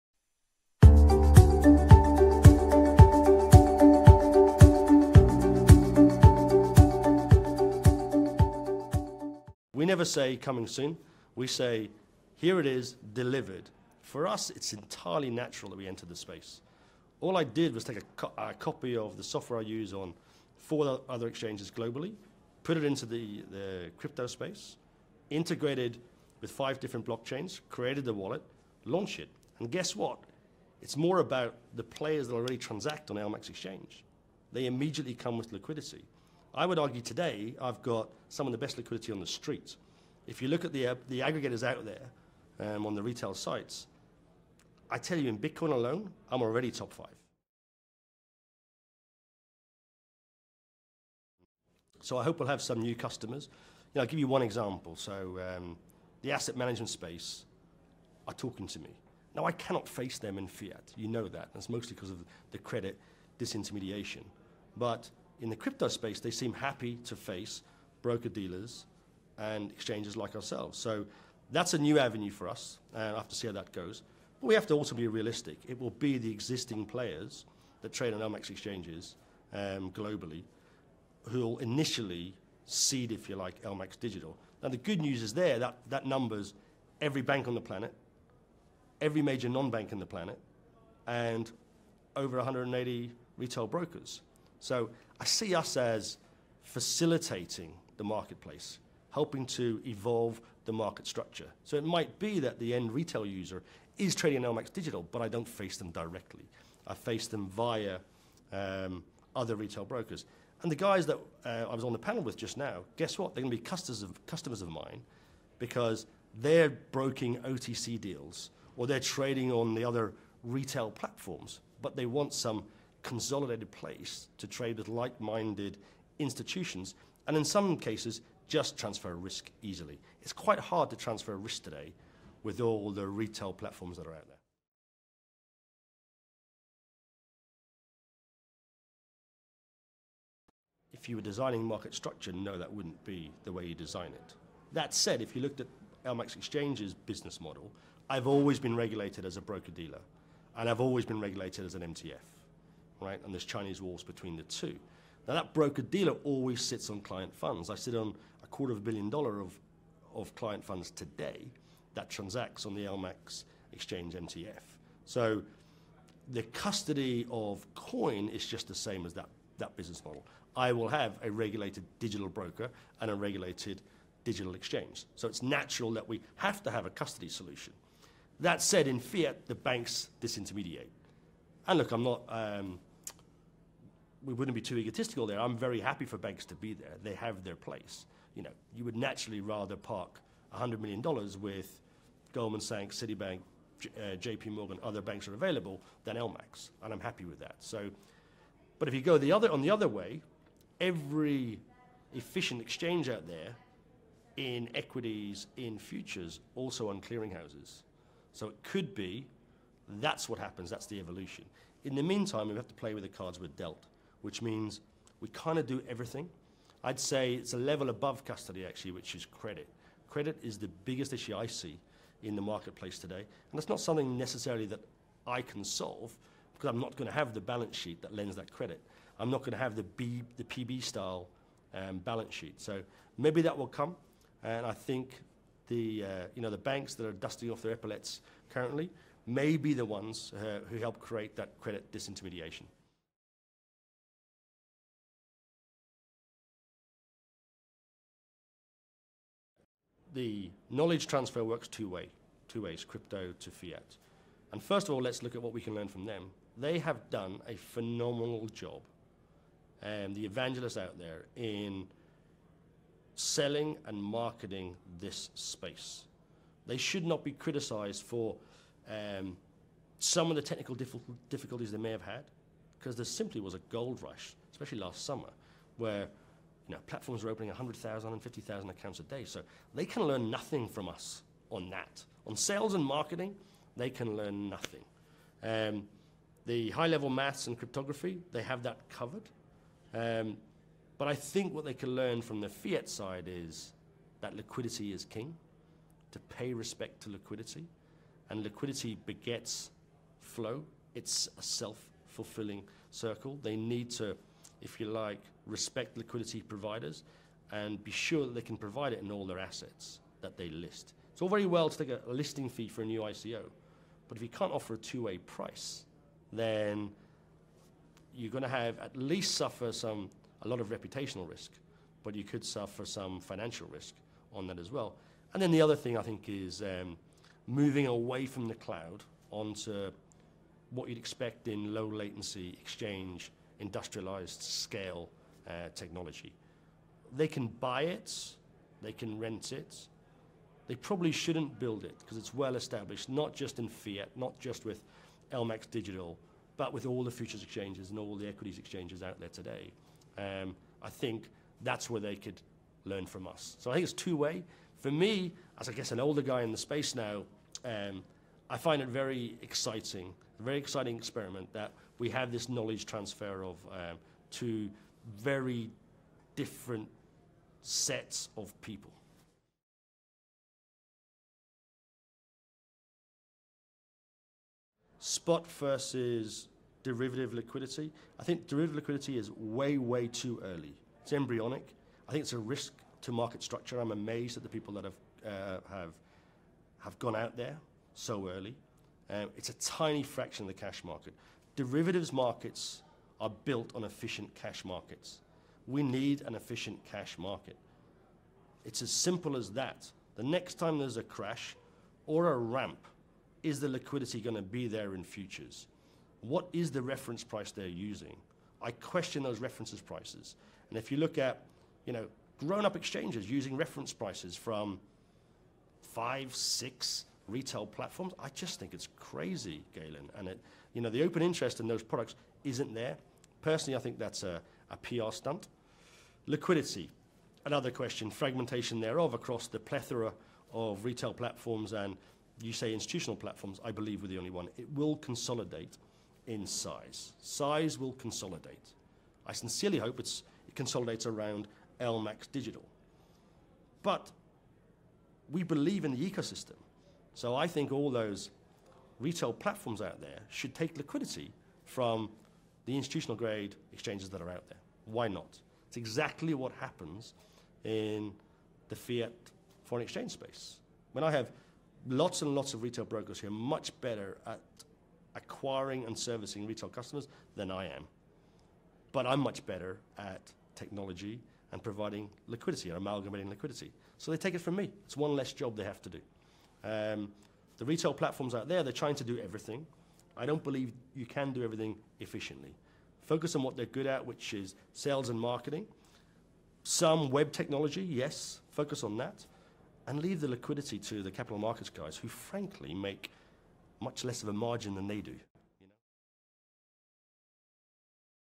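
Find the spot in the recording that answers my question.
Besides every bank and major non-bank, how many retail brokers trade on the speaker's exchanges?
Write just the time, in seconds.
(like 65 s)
92 s.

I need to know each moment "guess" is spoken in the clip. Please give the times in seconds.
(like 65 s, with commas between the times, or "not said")
29 s, 112 s, 355 s.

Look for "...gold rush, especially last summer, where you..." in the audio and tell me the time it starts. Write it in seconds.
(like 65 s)
273 s.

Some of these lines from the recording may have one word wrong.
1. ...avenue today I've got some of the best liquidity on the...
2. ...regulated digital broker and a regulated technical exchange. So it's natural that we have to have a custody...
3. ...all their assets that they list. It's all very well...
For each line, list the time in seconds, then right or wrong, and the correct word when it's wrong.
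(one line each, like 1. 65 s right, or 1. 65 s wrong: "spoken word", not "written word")
1. 36 s wrong: "argue", not "avenue"
2. 171 s wrong: "digital", not "technical"
3. 309 s right.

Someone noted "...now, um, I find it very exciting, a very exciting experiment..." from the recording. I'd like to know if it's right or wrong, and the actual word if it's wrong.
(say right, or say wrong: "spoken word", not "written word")
right.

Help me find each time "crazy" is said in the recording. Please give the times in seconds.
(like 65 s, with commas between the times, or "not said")
418 s.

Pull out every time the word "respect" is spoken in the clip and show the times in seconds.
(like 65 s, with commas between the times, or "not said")
296 s, 305 s.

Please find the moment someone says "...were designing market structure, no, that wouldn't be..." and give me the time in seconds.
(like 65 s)
141 s.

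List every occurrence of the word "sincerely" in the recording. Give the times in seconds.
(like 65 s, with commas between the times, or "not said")
439 s.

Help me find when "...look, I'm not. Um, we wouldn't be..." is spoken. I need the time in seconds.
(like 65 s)
181 s.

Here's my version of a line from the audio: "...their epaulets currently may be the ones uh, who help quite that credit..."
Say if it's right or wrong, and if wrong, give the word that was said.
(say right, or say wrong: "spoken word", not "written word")
wrong: "create", not "quite".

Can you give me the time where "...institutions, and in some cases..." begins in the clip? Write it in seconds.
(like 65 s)
126 s.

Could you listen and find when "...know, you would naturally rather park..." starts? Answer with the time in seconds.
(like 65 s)
188 s.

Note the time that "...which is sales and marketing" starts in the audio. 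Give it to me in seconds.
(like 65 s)
484 s.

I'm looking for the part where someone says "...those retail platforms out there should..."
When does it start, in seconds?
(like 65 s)
447 s.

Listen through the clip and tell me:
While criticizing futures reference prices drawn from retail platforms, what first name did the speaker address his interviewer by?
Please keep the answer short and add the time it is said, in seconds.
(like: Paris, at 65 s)
Galen, at 419 s.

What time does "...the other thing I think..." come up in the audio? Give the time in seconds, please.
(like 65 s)
325 s.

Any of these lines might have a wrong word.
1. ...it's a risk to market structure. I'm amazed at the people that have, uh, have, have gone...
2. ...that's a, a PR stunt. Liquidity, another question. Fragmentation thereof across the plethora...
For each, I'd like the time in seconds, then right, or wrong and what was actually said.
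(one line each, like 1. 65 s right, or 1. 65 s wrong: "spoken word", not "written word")
1. 382 s right
2. 423 s right.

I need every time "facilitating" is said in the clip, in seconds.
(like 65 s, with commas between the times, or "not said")
96 s.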